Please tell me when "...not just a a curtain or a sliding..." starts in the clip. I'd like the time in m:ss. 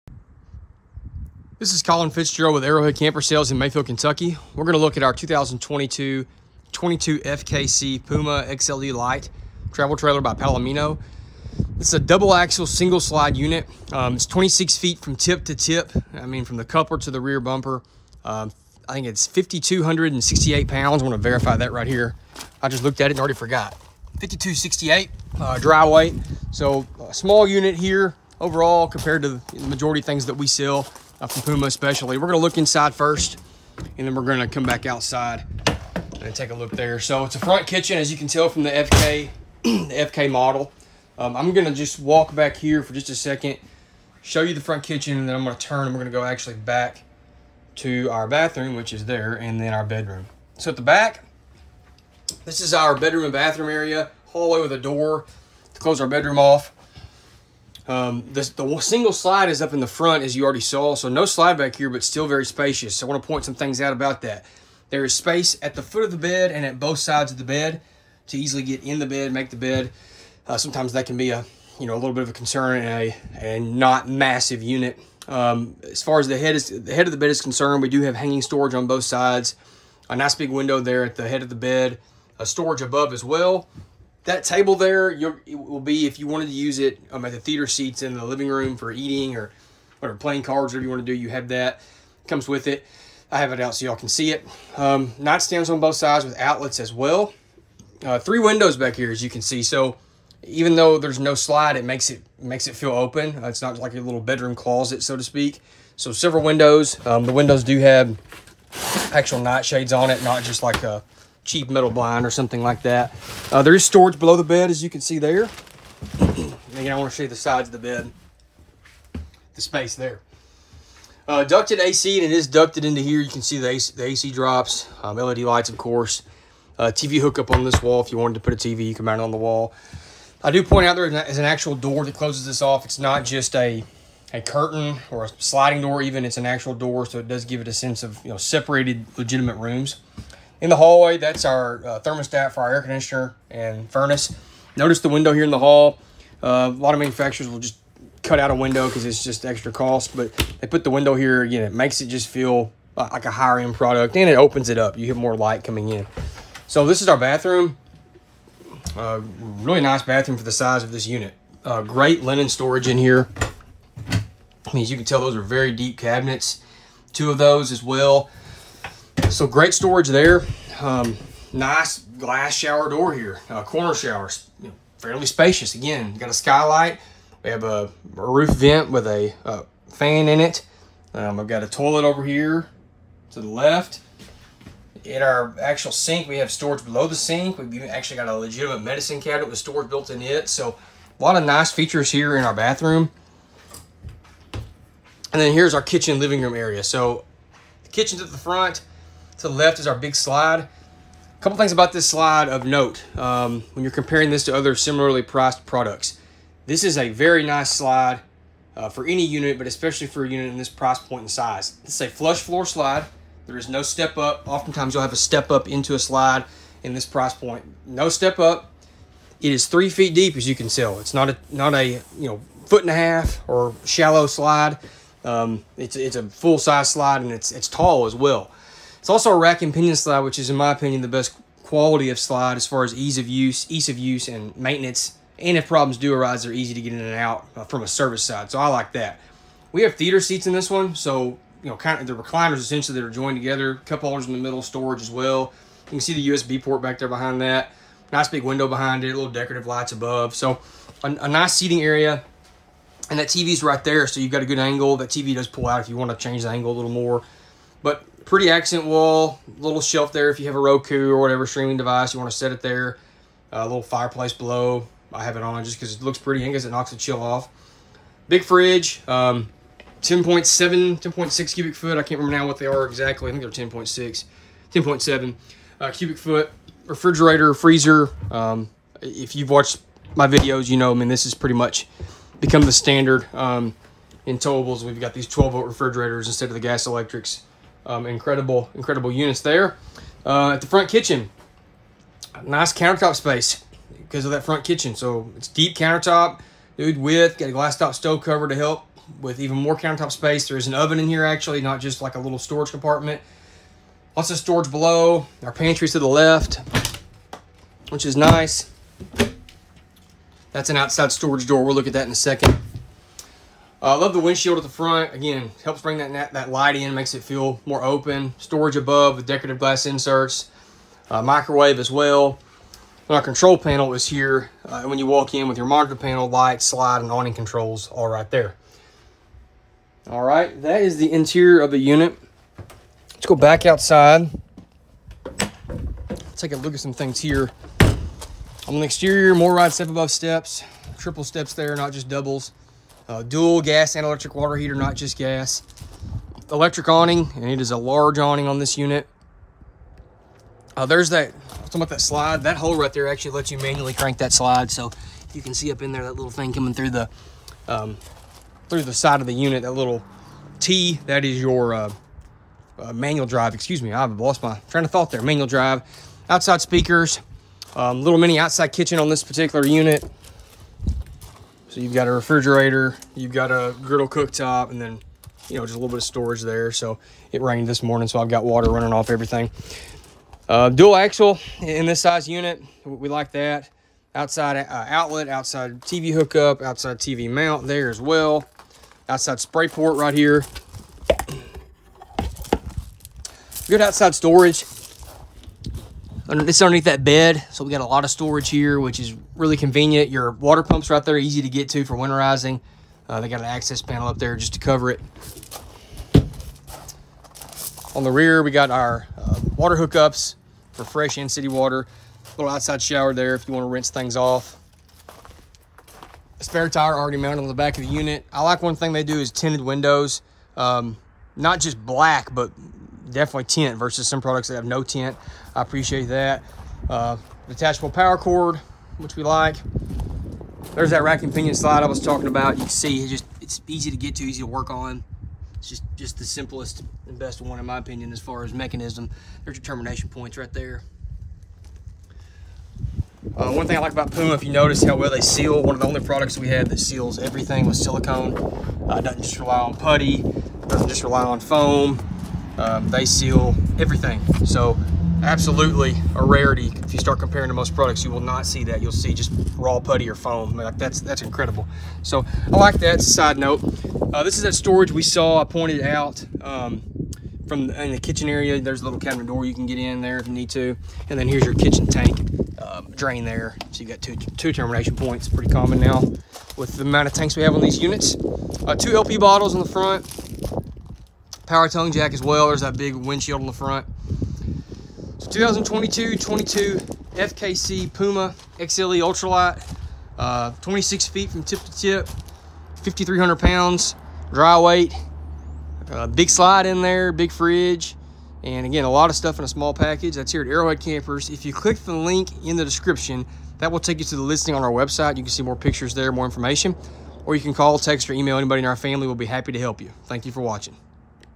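2:12.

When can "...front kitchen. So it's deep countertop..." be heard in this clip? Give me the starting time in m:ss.
4:54.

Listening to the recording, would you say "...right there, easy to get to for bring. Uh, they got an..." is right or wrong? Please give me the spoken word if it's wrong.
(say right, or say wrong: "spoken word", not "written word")
wrong: "winterizing", not "bring".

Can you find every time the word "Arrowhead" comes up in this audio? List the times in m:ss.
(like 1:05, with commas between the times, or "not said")
0:02, 8:20.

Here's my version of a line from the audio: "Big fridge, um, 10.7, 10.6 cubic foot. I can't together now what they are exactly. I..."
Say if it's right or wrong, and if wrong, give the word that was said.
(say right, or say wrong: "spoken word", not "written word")
wrong: "remember", not "together".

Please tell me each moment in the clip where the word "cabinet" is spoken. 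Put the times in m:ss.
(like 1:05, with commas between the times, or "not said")
2:45, 3:09, 7:48.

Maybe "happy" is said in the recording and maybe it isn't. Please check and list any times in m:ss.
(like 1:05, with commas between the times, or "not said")
8:29.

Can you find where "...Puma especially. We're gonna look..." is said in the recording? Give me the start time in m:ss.
0:31.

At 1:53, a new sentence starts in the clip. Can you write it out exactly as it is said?
Uh, there is storage below the bed, as you can see there.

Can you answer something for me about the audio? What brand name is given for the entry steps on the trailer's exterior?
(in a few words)
MORryde.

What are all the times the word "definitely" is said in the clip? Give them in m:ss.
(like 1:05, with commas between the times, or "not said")
7:03.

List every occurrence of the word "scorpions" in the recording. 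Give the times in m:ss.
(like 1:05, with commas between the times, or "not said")
not said.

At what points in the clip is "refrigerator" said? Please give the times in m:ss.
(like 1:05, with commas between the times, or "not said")
4:36, 4:45, 6:12.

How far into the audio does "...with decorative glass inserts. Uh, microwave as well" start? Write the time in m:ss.
5:19.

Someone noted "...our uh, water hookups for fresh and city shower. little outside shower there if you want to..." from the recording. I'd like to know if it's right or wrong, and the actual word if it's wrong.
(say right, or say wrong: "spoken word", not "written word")
wrong: "water", not "shower".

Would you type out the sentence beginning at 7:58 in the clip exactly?
Uh, two LP bottles on the front power tongue jack as well.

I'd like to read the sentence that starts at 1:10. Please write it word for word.
Uh, sometimes that can be a you know a little bit of a concern and a and not massive unit.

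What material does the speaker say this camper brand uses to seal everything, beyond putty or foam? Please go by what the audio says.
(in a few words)
Silicone.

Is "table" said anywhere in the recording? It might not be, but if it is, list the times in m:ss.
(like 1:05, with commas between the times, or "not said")
1:24.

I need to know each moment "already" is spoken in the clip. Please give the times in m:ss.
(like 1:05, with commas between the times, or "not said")
0:23, 1:00, 6:56.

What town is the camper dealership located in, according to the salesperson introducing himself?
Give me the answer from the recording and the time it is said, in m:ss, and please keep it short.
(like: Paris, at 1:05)
Mayfield, Kentucky, at 0:03.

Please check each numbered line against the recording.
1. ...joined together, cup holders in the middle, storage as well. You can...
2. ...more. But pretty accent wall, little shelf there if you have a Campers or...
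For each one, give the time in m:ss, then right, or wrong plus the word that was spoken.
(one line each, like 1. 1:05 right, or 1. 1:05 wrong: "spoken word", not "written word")
1. 4:03 right
2. 4:16 wrong: "Roku", not "Campers".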